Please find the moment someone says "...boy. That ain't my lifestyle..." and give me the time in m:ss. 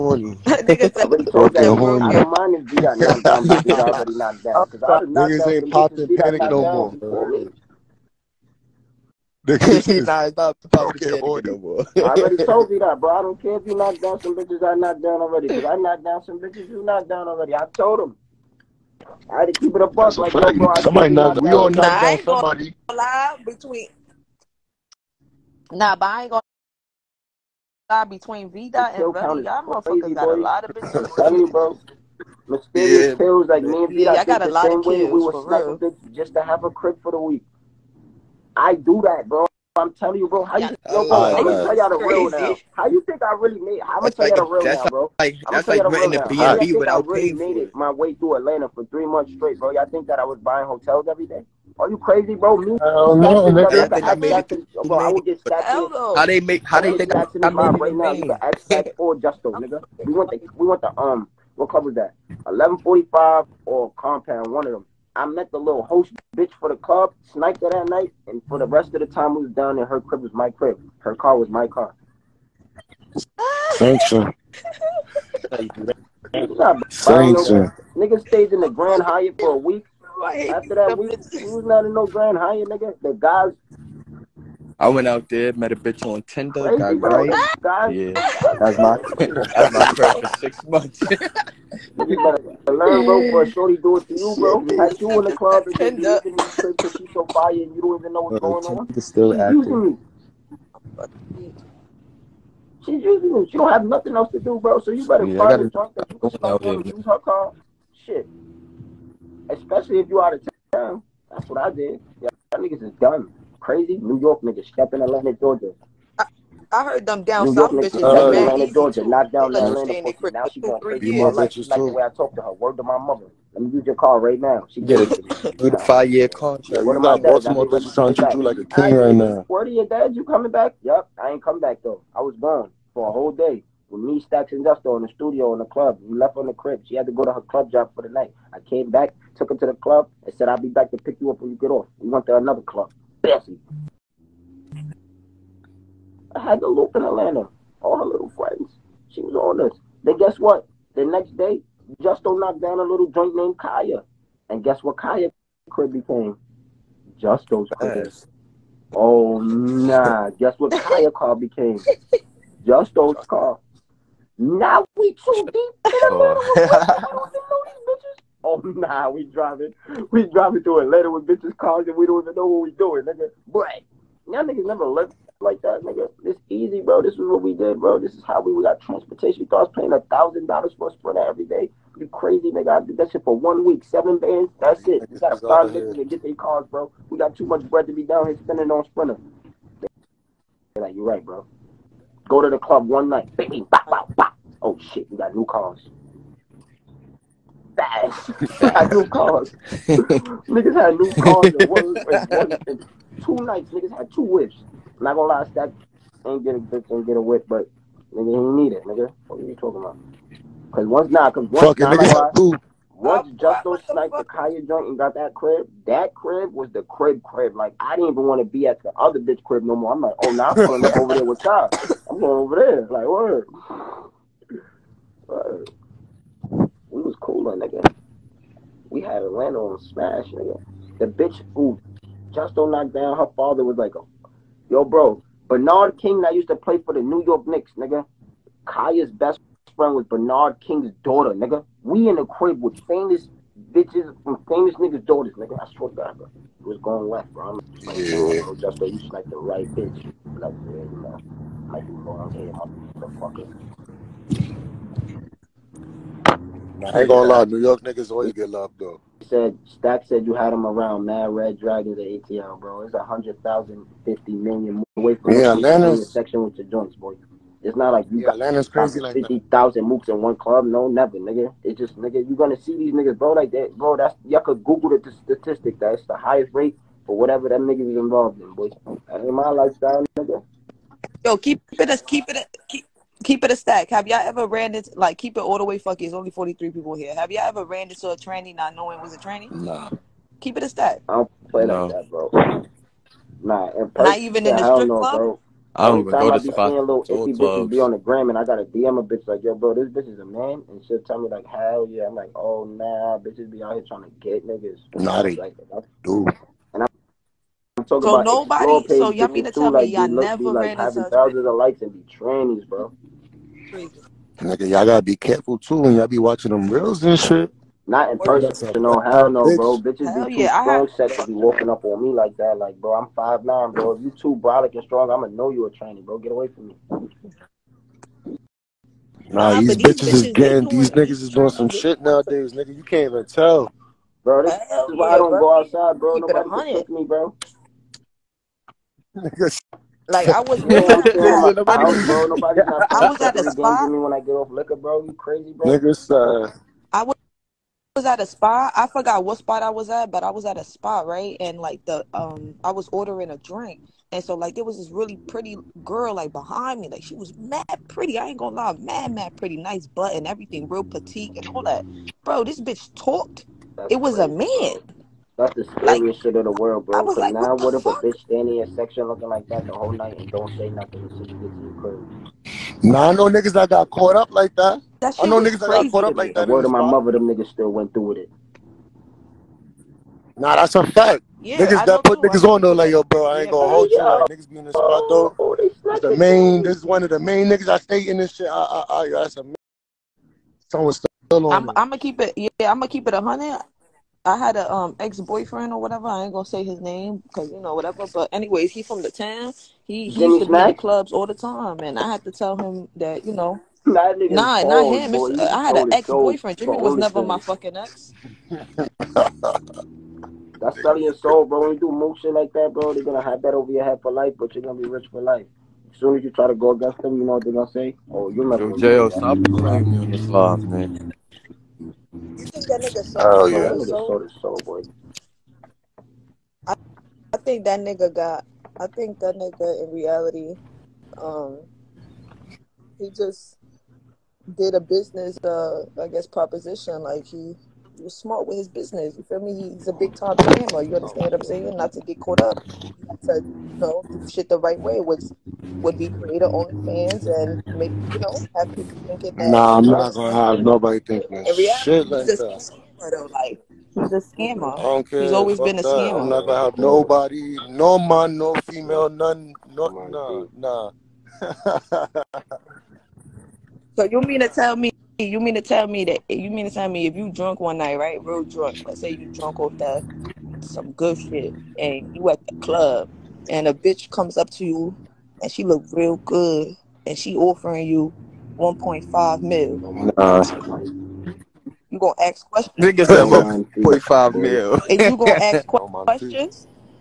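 4:38.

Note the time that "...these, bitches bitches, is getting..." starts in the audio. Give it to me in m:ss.
5:29.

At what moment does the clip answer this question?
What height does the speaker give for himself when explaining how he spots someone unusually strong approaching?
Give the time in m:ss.
5:23.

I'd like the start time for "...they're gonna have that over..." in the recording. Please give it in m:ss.
6:52.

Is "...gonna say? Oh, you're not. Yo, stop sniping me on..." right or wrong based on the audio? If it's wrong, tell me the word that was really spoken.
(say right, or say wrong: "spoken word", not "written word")
wrong: "playing", not "sniping".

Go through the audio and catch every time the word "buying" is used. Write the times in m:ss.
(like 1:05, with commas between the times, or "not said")
0:50.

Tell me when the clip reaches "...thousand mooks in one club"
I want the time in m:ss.
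4:29.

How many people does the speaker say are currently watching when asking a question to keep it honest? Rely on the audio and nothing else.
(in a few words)
43.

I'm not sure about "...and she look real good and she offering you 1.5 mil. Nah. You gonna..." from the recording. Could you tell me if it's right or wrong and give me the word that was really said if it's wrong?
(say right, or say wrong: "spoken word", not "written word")
right.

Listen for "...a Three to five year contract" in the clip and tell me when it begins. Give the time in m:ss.
2:05.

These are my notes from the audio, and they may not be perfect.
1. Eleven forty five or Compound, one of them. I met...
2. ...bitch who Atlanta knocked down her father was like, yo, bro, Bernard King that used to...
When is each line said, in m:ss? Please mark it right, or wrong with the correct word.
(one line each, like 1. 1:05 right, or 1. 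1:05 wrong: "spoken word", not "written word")
1. 1:02 right
2. 3:51 wrong: "Justo", not "Atlanta".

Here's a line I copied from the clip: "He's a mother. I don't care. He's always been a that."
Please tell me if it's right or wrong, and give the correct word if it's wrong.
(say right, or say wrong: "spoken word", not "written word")
wrong: "scammer", not "mother".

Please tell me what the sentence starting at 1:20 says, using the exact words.
After that, we, we was not in no Grand Hyatt, nigga.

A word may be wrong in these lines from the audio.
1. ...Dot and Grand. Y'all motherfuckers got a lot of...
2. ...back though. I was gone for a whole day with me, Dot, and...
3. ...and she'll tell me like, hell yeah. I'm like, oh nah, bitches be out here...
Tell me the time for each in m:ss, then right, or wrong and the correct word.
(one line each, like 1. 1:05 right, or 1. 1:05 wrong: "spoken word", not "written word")
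1. 0:28 wrong: "Belly", not "Grand"
2. 2:11 wrong: "Stacks", not "Dot"
3. 5:00 right.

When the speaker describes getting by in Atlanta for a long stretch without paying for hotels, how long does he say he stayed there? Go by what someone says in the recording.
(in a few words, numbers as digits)
3 months.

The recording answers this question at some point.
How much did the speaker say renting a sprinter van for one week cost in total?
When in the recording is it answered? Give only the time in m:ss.
3:03.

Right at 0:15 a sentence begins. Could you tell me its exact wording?
Because I knocked down some bitches you knocked down already.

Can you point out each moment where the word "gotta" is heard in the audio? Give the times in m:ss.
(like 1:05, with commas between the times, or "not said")
3:05, 5:14.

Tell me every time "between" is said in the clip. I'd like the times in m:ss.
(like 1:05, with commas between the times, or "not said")
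0:23, 0:28.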